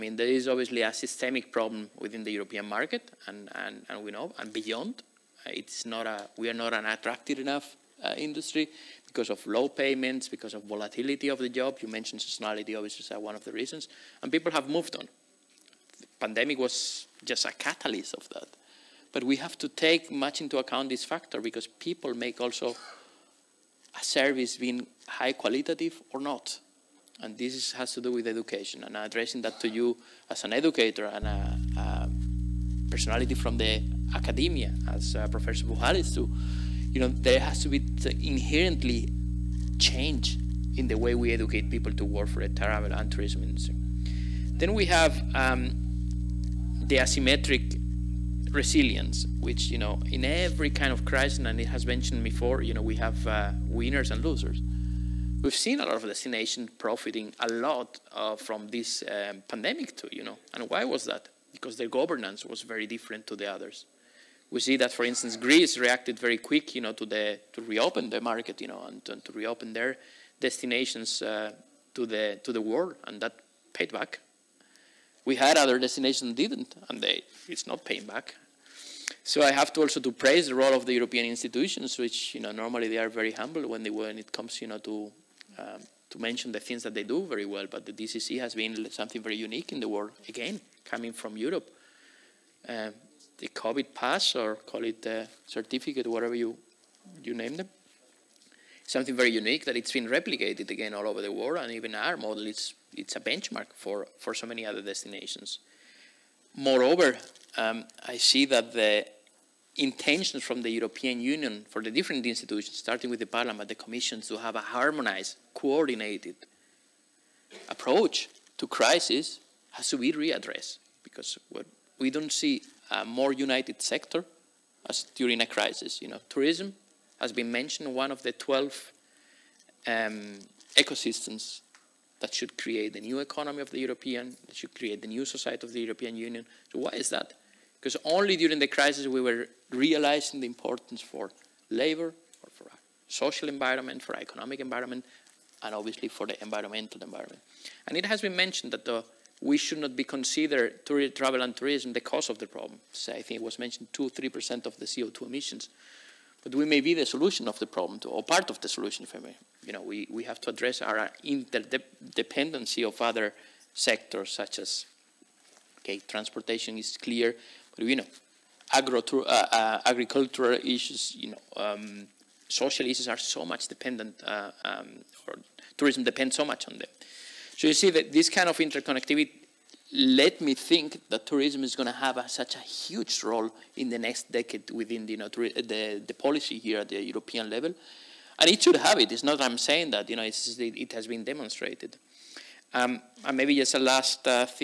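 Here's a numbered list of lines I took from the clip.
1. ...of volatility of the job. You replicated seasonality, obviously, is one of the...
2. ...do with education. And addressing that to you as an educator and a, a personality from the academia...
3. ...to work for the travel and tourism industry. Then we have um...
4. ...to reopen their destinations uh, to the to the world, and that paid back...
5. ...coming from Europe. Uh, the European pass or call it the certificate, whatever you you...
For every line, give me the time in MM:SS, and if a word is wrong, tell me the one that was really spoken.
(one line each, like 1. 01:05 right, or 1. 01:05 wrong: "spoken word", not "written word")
1. 00:10 wrong: "mentioned", not "replicated"
2. 00:28 right
3. 00:41 right
4. 01:09 right
5. 01:30 wrong: "COVID", not "European".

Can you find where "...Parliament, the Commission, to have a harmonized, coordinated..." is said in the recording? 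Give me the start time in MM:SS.
01:53.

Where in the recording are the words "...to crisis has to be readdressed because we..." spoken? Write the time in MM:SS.
01:58.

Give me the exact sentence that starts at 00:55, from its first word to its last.
We've seen a lot of destinations profiting a lot uh, from this um, pandemic too, you know.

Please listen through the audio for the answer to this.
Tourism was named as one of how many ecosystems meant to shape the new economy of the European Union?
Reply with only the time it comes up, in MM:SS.
02:08.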